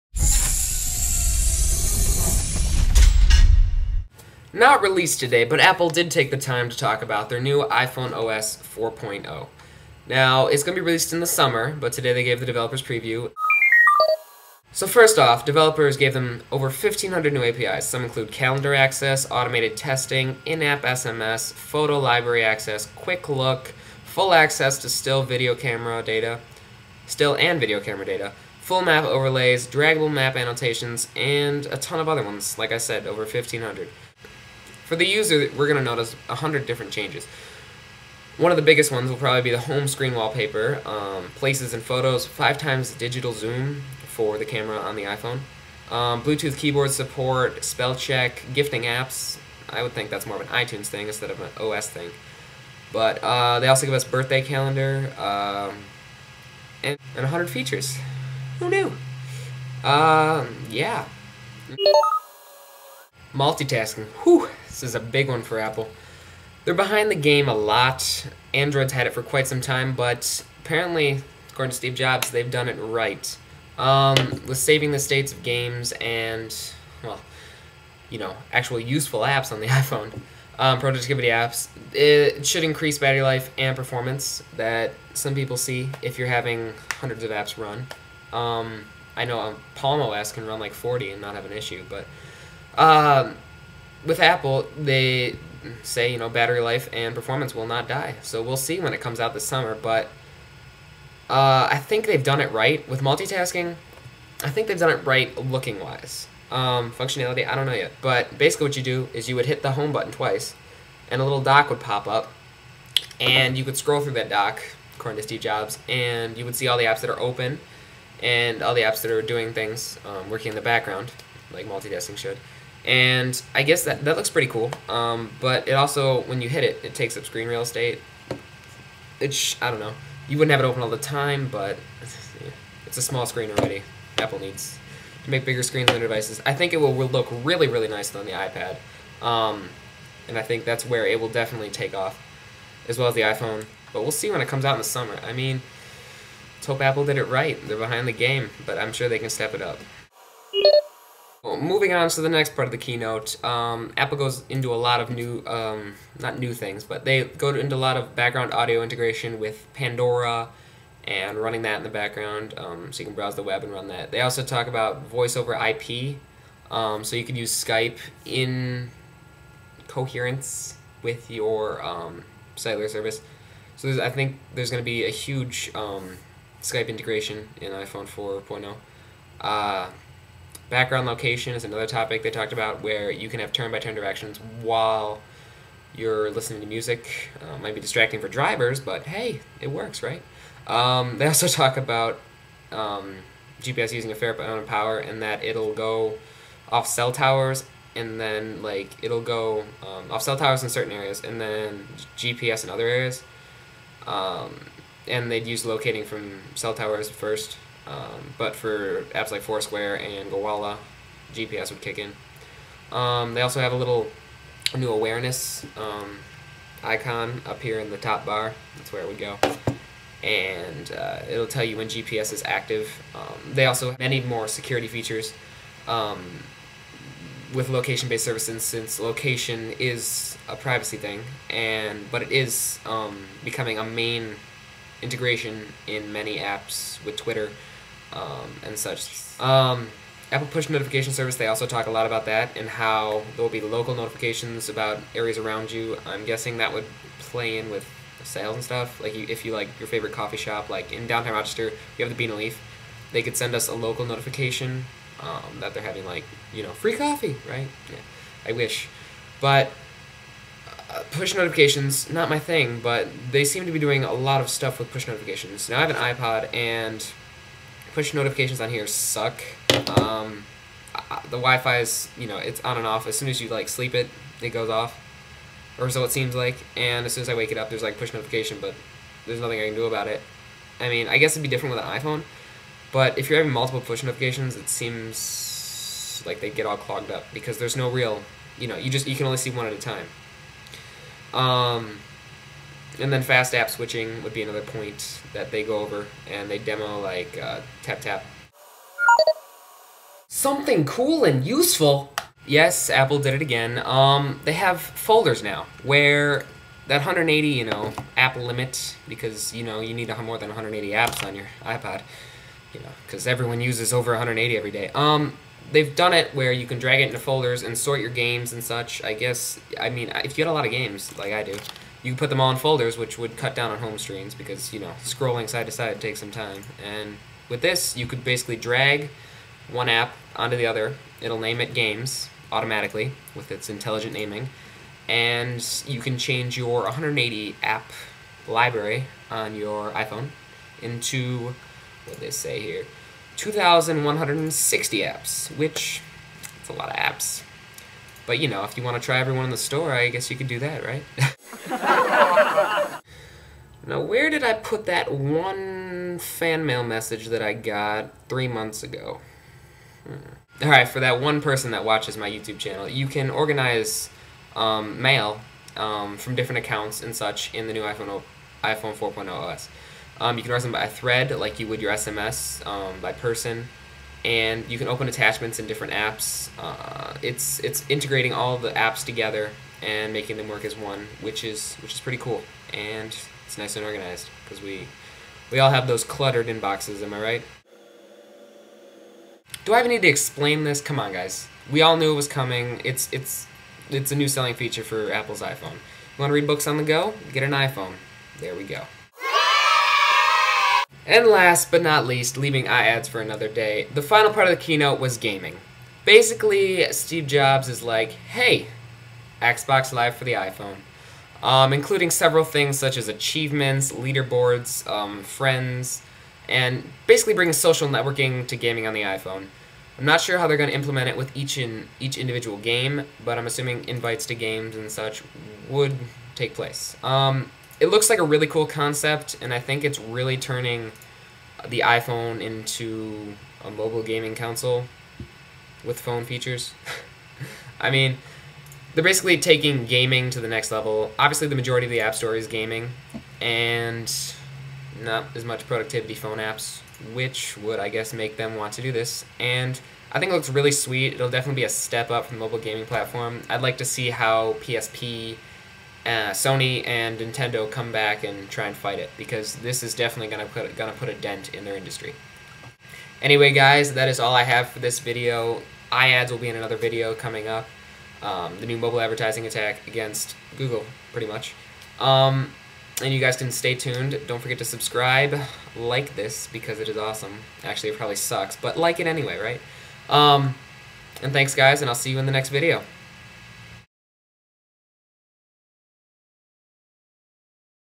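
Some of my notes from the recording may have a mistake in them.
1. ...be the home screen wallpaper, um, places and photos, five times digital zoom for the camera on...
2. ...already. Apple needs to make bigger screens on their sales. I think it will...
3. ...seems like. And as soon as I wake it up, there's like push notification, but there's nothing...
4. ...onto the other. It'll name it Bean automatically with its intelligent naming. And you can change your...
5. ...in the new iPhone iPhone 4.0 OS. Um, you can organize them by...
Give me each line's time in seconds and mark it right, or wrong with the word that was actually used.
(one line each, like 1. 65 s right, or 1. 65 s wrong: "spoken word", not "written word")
1. 39 s right
2. 133 s wrong: "devices", not "sales"
3. 276 s right
4. 330 s wrong: "Games", not "Bean"
5. 367 s right.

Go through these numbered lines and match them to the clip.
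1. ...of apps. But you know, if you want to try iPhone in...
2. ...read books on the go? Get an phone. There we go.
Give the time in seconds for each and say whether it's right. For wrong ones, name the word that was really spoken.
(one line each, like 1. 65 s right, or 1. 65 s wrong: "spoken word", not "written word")
1. 346 s wrong: "everyone", not "iPhone"
2. 396 s wrong: "iPhone", not "phone".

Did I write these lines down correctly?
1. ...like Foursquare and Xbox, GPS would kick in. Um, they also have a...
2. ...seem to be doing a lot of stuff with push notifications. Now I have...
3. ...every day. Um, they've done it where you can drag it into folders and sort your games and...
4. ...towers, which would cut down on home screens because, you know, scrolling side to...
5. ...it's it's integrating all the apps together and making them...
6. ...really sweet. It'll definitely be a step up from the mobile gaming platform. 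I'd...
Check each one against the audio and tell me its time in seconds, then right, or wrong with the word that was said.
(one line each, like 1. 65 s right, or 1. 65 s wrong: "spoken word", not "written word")
1. 209 s wrong: "Gowalla", not "Xbox"
2. 263 s right
3. 314 s right
4. 322 s wrong: "folders", not "towers"
5. 377 s right
6. 450 s right.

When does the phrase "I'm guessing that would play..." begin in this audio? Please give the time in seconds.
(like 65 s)
246 s.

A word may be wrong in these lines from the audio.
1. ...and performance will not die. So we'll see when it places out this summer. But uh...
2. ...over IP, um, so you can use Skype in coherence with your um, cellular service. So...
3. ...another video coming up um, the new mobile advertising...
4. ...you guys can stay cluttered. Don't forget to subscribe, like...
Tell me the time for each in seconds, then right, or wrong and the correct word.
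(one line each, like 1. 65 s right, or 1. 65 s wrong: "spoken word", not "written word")
1. 96 s wrong: "comes", not "places"
2. 165 s right
3. 466 s right
4. 473 s wrong: "tuned", not "cluttered".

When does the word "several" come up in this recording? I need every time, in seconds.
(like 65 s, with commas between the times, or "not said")
412 s.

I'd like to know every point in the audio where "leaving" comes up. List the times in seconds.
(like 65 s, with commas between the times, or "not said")
402 s.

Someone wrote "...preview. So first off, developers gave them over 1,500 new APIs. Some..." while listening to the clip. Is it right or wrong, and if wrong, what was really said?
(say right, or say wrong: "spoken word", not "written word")
right.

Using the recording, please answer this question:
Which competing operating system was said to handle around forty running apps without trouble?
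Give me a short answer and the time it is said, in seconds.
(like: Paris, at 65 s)
Palm OS, at 89 s.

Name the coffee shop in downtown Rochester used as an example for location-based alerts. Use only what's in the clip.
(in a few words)
Bean and Leaf.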